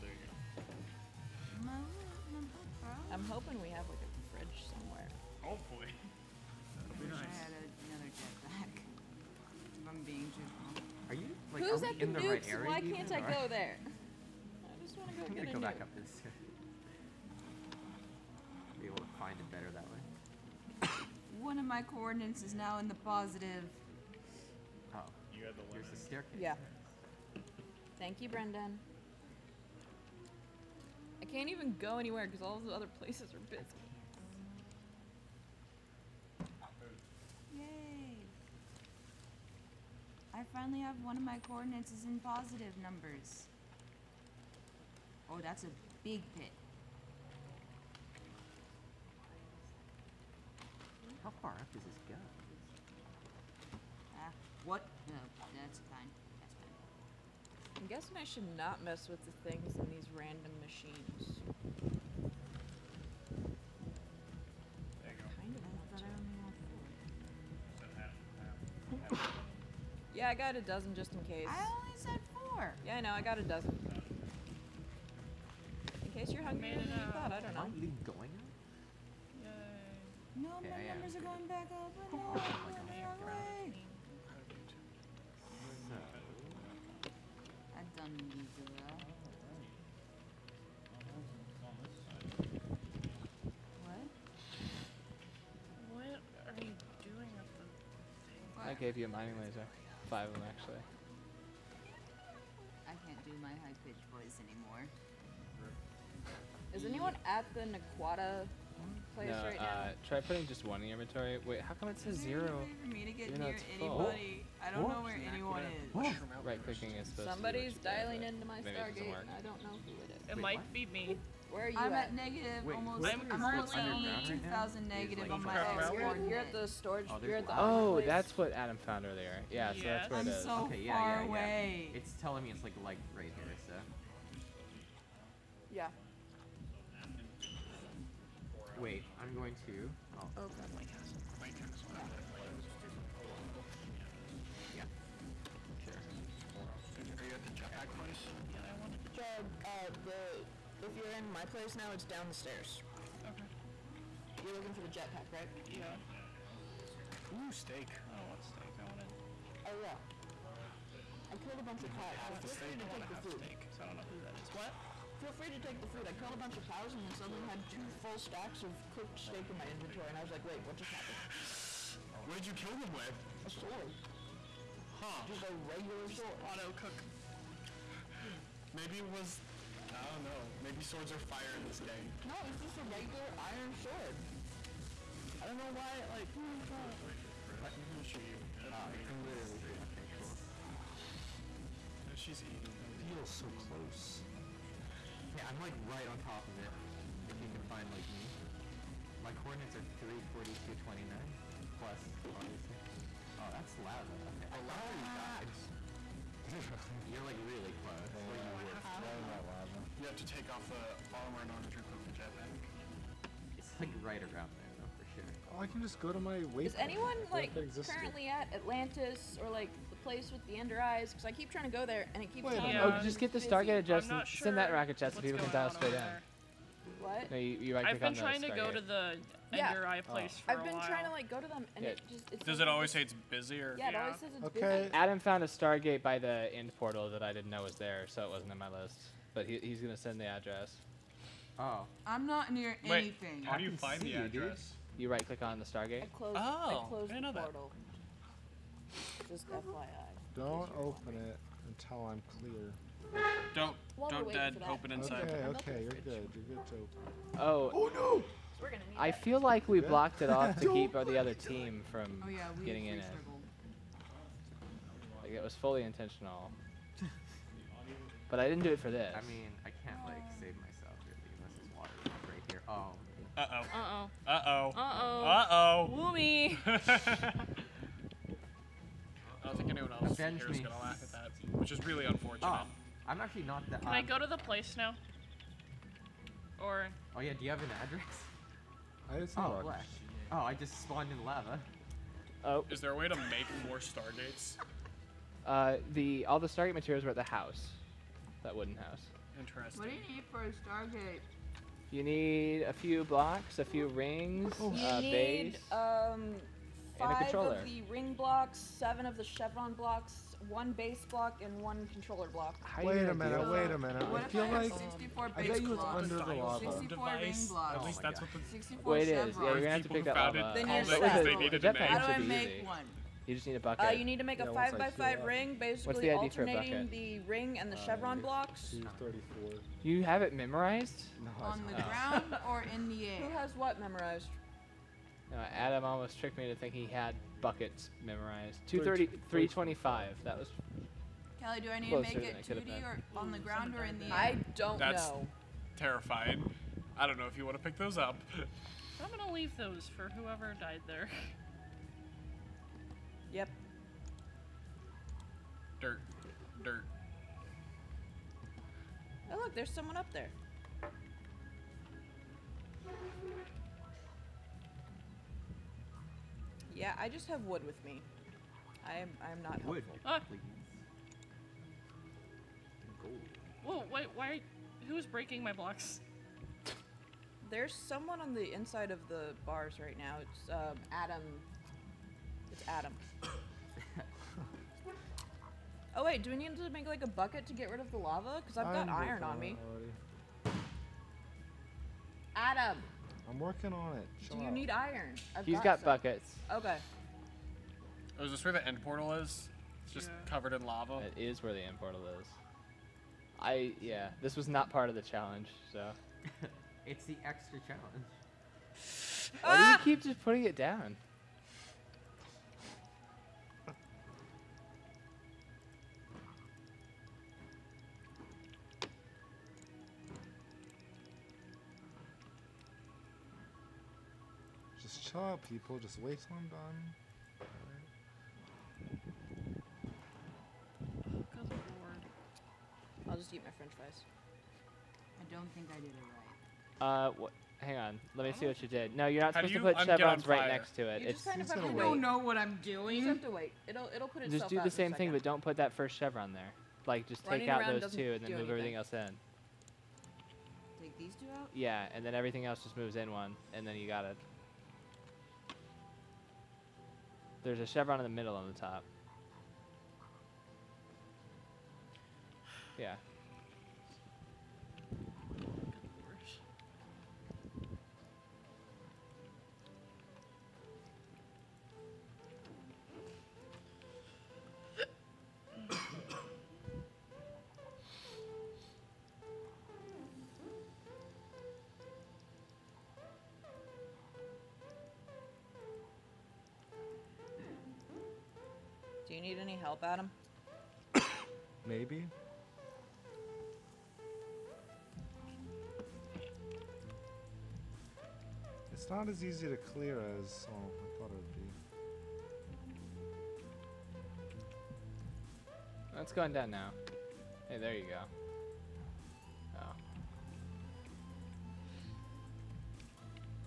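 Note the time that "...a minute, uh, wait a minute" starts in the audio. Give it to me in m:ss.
5:13.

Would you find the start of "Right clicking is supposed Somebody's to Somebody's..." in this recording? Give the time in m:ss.
1:56.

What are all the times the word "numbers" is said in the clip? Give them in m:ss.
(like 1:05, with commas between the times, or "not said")
0:42, 1:20.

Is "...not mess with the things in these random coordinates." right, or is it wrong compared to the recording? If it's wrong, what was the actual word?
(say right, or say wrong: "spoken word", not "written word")
wrong: "machines", not "coordinates".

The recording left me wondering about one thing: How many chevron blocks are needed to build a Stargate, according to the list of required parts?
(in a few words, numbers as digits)
7.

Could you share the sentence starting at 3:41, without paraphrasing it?
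Because I keep trying to go there and it keeps.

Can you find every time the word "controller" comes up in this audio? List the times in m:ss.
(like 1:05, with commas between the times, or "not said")
5:07, 5:11.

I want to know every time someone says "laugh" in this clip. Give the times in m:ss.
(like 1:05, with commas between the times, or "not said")
4:40.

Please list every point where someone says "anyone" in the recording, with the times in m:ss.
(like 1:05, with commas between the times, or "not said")
1:46, 1:55, 3:36, 4:39.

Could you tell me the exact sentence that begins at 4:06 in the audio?
I closed, oh, I closed I know the portal.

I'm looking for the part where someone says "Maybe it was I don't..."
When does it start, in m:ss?
2:58.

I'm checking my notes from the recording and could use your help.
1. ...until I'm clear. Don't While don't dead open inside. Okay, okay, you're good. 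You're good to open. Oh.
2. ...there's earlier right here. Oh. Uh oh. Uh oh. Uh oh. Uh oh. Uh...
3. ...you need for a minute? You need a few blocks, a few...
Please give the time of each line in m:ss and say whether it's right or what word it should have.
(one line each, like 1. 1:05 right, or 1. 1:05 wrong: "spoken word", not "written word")
1. 4:11 right
2. 4:31 wrong: "water", not "earlier"
3. 4:59 wrong: "stargate", not "minute".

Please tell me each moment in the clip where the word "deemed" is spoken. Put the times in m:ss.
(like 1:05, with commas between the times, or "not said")
not said.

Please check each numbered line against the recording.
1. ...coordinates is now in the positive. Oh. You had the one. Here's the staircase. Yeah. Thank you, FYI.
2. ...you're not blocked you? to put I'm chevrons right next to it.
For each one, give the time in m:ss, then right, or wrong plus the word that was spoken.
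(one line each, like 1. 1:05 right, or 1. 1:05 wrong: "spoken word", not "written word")
1. 0:21 wrong: "Brendan", not "FYI"
2. 7:19 wrong: "supposed", not "blocked".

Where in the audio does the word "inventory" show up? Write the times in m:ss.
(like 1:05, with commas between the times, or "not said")
1:51, 2:49.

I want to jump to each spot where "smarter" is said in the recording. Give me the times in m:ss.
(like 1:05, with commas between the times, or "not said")
not said.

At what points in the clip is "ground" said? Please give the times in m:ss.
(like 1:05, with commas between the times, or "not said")
5:31, 5:43.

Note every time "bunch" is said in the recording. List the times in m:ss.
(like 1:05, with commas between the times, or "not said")
2:41, 2:46.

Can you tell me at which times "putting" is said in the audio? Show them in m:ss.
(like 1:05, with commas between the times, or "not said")
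1:50, 6:50.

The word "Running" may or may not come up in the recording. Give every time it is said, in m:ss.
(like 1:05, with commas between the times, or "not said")
7:27.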